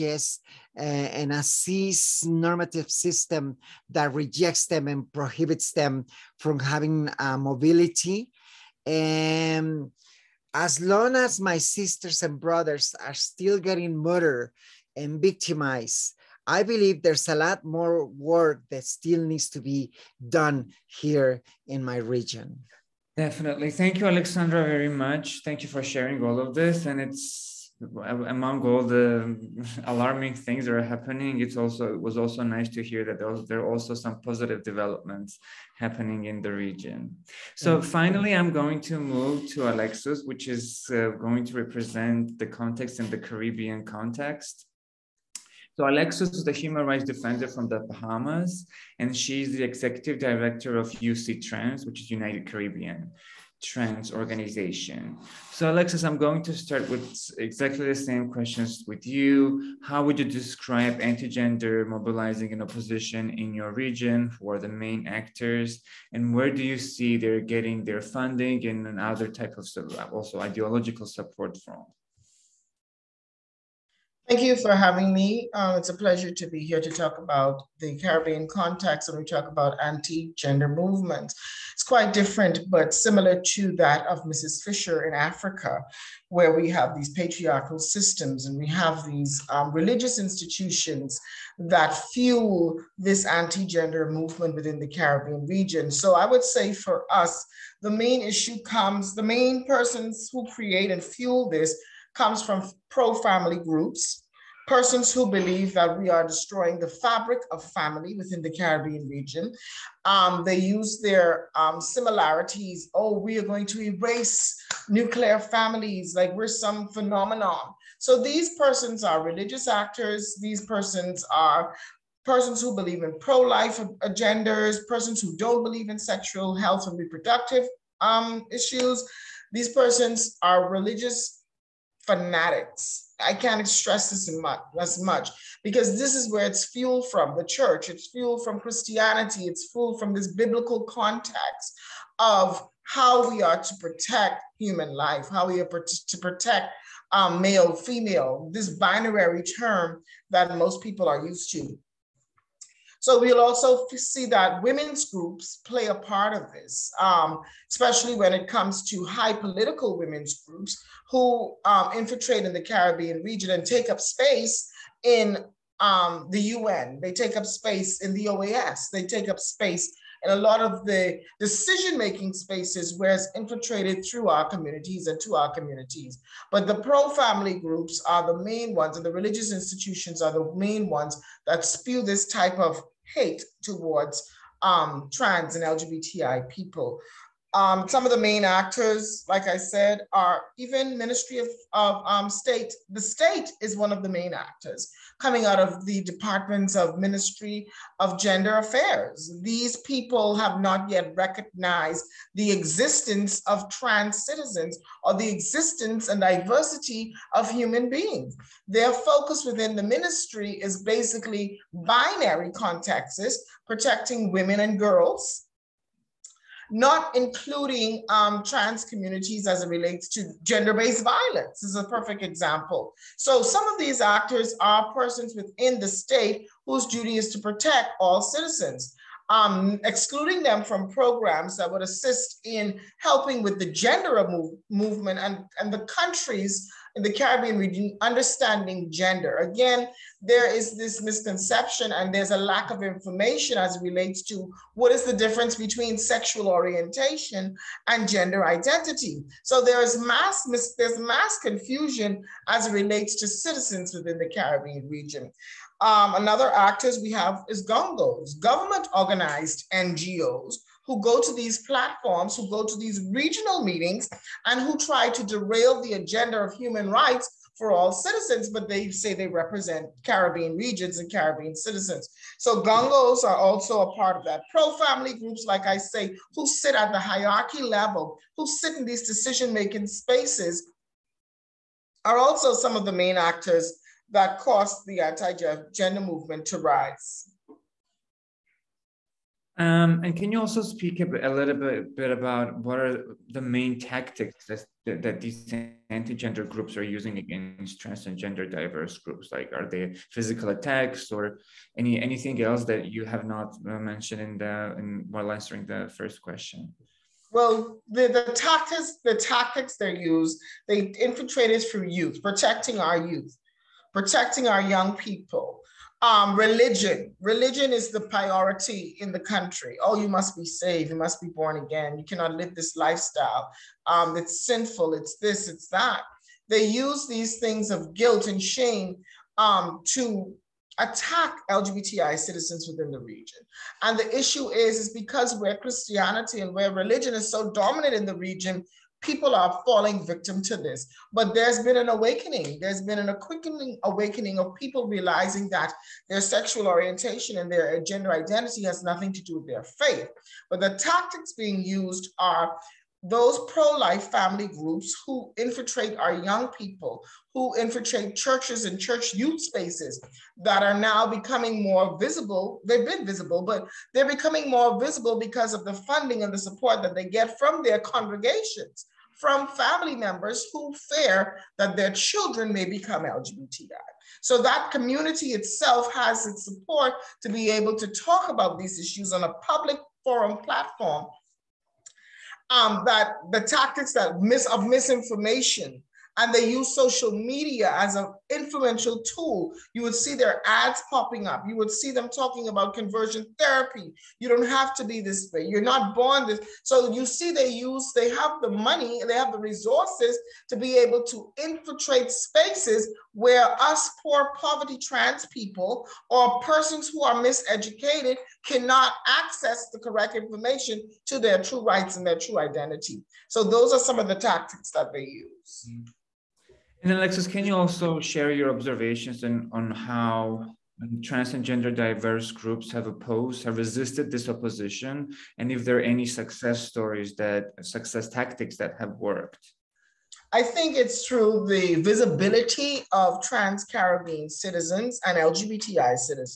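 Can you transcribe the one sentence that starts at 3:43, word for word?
So some of these actors are persons within the state whose duty is to protect all citizens.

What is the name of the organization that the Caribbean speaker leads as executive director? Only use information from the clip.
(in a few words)
UCTRANS.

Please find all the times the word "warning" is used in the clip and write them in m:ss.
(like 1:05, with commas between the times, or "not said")
not said.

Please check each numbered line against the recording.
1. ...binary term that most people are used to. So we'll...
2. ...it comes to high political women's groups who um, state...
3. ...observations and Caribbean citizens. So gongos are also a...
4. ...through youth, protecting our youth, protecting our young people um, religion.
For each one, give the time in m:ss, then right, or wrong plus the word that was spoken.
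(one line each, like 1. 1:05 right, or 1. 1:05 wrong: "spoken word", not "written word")
1. 2:28 right
2. 2:38 wrong: "infiltrate", not "state"
3. 4:30 wrong: "regions", not "observations"
4. 5:11 right.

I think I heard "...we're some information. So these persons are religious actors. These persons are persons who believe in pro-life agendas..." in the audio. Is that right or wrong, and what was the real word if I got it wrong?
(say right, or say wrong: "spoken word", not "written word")
wrong: "phenomenon", not "information".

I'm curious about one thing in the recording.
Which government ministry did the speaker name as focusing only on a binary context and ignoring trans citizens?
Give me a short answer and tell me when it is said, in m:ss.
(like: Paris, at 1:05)
Ministry of Gender Affairs, at 3:16.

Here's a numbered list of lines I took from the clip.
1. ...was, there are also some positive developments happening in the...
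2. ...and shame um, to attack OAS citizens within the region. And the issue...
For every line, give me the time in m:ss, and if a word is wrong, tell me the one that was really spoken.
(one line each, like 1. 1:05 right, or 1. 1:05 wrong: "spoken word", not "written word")
1. 0:33 right
2. 5:28 wrong: "LGBTI", not "OAS".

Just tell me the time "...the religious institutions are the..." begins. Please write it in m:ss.
2:59.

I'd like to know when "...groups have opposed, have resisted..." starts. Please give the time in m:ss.
7:02.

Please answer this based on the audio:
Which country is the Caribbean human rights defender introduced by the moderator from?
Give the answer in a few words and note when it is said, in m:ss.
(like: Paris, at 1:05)
The Bahamas, at 0:47.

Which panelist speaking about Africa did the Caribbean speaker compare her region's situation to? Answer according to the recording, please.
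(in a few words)
Mrs. Fisher.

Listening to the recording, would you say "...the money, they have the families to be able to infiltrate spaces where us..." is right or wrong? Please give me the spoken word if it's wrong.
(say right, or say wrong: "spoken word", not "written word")
wrong: "resources", not "families".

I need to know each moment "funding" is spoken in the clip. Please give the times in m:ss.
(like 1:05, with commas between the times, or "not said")
1:08, 6:05.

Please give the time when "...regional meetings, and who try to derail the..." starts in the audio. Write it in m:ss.
4:23.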